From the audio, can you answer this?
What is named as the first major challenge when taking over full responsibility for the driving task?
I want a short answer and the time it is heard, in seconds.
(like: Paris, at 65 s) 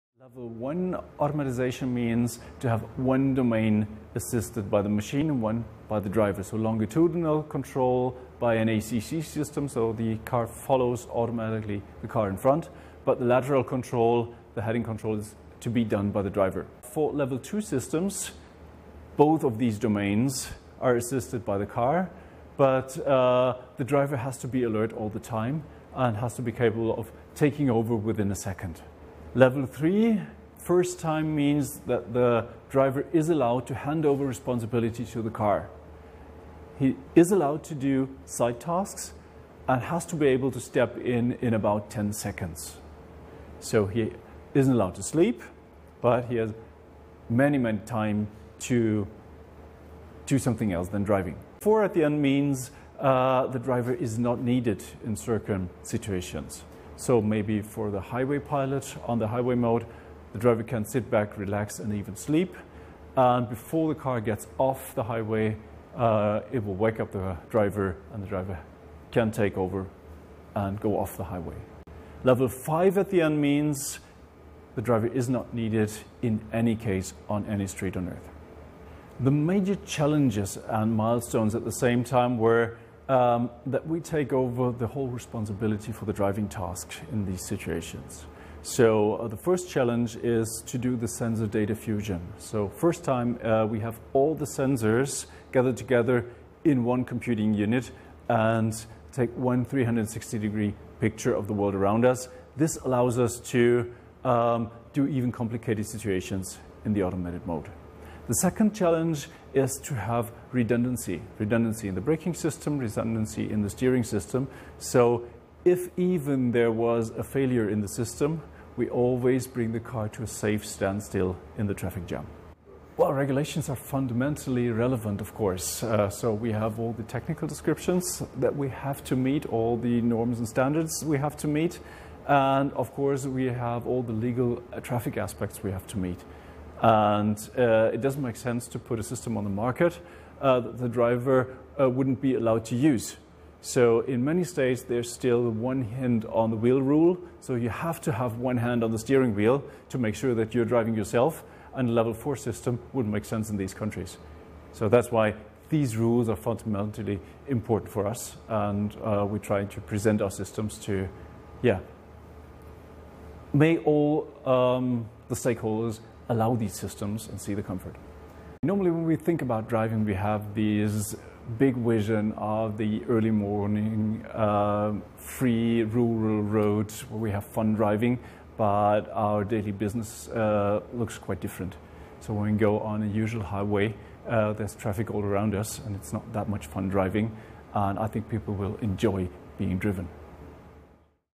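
sensor data fusion, at 91 s.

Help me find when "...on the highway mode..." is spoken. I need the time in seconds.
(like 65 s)
59 s.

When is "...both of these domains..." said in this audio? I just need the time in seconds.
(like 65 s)
19 s.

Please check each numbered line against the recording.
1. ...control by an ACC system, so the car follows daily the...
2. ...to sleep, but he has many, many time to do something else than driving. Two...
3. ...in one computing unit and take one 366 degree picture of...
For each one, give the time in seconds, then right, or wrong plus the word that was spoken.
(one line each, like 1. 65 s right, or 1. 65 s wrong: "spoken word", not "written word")
1. 7 s wrong: "automatically", not "daily"
2. 44 s wrong: "Four", not "Two"
3. 96 s wrong: "360", not "366".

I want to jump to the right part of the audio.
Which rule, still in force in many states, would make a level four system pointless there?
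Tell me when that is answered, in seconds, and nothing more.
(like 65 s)
145 s.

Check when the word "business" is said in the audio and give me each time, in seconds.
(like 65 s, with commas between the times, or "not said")
179 s.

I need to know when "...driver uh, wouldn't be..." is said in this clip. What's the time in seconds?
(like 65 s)
140 s.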